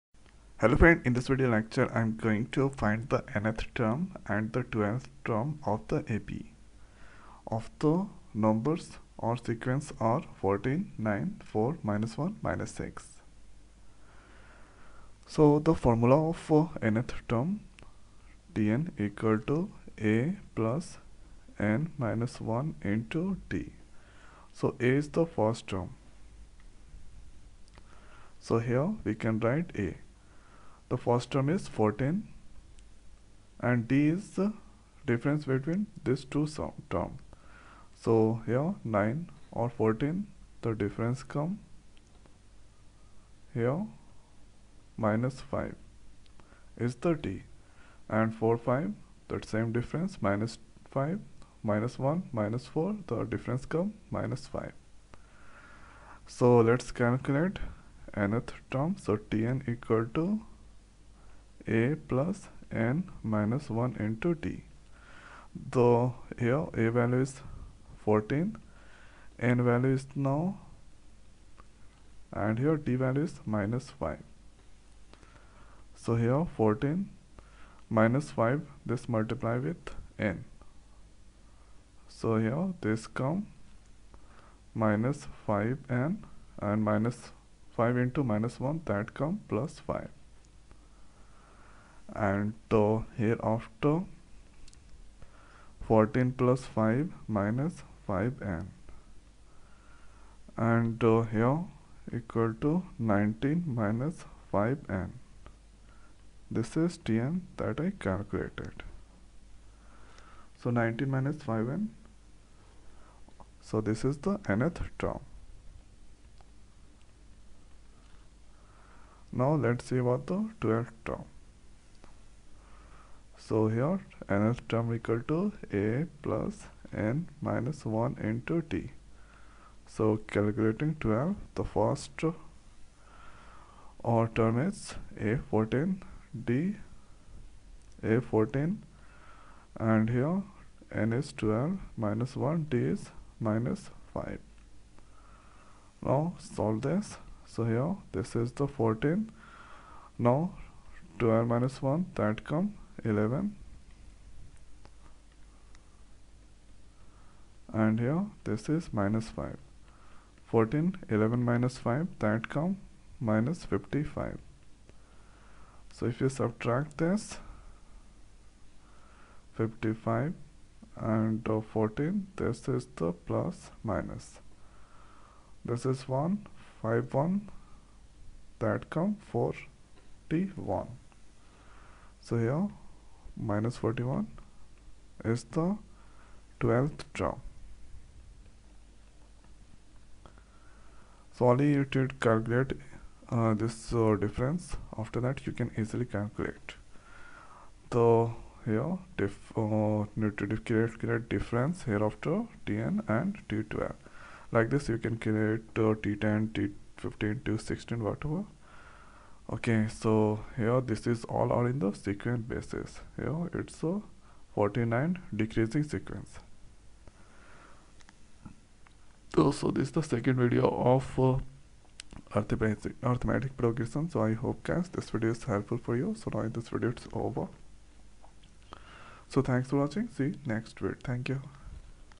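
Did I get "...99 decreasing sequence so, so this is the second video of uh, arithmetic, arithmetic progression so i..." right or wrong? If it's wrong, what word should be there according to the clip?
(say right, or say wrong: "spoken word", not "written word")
wrong: "49", not "99".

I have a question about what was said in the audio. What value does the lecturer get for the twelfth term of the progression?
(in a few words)
-41.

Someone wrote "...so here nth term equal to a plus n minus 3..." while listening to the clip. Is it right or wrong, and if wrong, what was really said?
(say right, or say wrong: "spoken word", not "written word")
wrong: "1", not "3".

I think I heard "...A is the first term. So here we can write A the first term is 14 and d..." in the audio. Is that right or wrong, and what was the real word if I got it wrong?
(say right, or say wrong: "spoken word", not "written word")
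right.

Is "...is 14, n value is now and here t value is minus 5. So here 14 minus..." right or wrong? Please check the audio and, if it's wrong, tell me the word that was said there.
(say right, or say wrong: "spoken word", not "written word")
right.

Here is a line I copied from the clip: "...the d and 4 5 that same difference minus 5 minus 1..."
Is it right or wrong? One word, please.
right.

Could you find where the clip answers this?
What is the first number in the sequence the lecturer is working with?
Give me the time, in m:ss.
0:10.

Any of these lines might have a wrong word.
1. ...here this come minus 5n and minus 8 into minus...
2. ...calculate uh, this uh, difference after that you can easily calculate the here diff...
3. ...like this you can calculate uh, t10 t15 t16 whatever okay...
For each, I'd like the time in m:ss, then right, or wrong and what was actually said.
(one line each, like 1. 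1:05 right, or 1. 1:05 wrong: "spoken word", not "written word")
1. 1:22 wrong: "5", not "8"
2. 3:12 right
3. 3:24 wrong: "create", not "calculate".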